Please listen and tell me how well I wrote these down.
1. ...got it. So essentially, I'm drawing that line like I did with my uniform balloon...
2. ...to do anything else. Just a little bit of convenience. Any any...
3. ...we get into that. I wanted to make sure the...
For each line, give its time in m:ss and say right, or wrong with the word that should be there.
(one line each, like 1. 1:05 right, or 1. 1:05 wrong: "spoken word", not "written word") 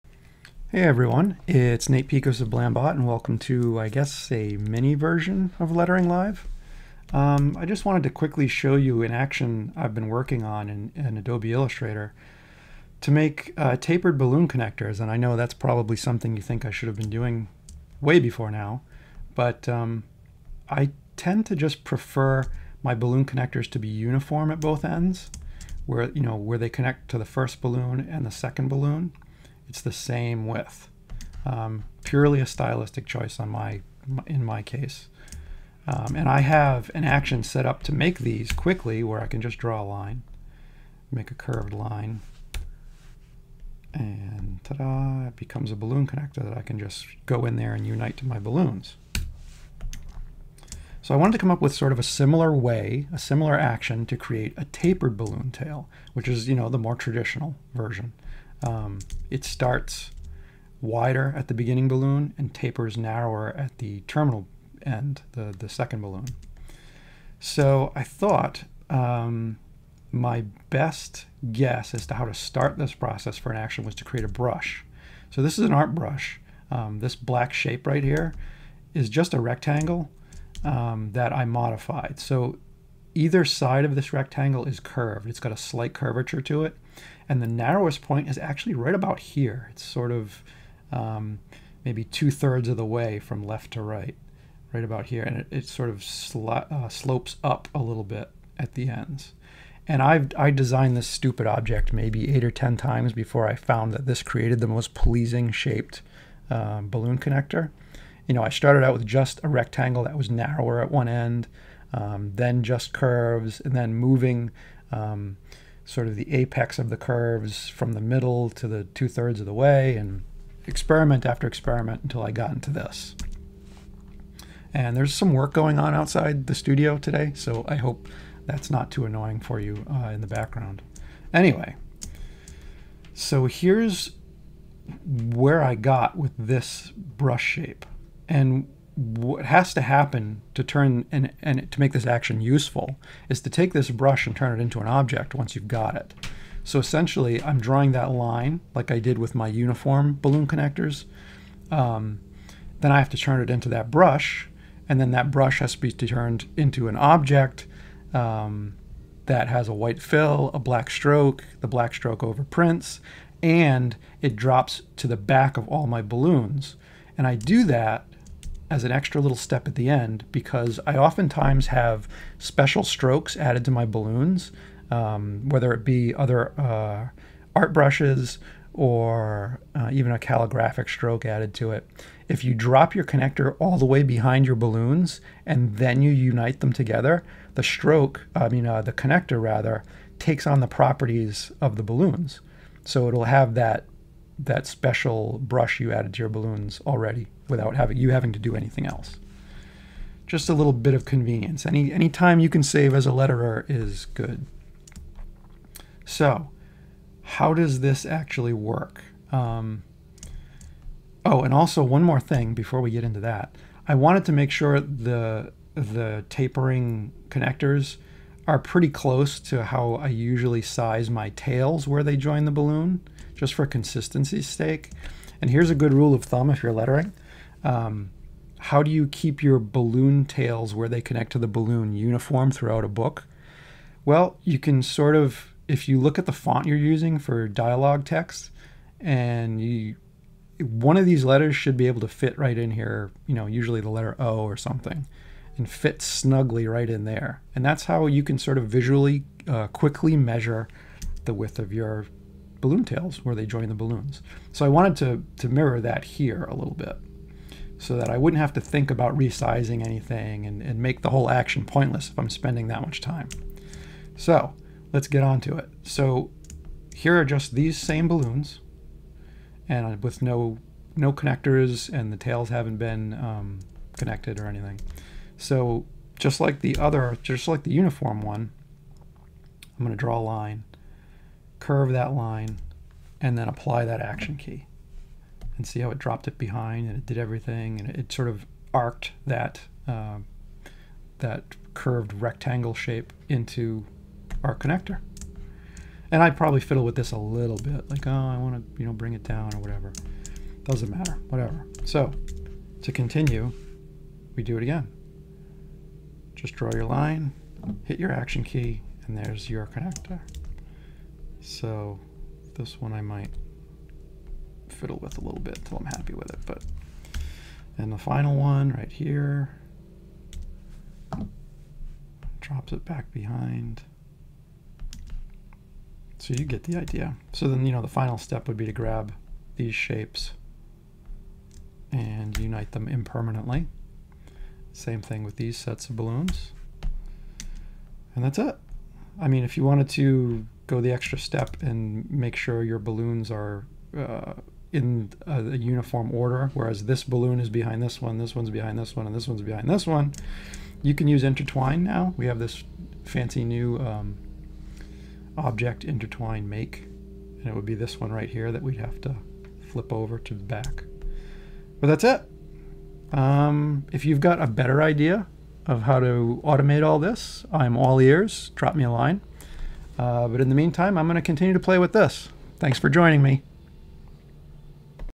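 1. 2:25 right
2. 3:18 right
3. 3:32 right.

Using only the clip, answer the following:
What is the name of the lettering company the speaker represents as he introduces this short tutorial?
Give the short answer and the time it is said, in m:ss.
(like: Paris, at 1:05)
Blambot, at 0:02.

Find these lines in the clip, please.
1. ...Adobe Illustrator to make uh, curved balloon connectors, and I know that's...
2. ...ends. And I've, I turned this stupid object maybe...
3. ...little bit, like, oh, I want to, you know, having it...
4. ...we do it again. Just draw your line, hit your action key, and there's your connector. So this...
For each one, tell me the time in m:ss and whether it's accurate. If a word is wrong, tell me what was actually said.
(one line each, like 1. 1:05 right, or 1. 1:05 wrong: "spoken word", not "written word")
1. 0:11 wrong: "tapered", not "curved"
2. 1:38 wrong: "designed", not "turned"
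3. 4:57 wrong: "bring", not "having"
4. 5:04 right.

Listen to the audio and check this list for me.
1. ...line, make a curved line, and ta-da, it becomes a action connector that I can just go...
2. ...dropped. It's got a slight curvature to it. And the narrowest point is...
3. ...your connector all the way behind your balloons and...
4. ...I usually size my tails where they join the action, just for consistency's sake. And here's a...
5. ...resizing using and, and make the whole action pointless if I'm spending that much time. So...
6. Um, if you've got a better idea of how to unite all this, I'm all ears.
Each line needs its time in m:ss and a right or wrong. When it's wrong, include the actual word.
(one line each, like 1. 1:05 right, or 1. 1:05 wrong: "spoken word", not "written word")
1. 0:39 wrong: "balloon", not "action"
2. 1:24 wrong: "curved", not "dropped"
3. 3:02 right
4. 3:39 wrong: "balloon", not "action"
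5. 4:19 wrong: "anything", not "using"
6. 6:03 wrong: "automate", not "unite".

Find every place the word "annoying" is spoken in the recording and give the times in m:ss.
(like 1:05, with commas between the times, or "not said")
2:09.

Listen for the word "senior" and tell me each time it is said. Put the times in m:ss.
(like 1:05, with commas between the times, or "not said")
not said.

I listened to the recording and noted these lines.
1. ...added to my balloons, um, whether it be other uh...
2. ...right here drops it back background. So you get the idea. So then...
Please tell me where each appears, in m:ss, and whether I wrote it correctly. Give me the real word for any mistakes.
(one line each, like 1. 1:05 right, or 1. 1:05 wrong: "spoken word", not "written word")
1. 2:53 right
2. 5:18 wrong: "behind", not "background".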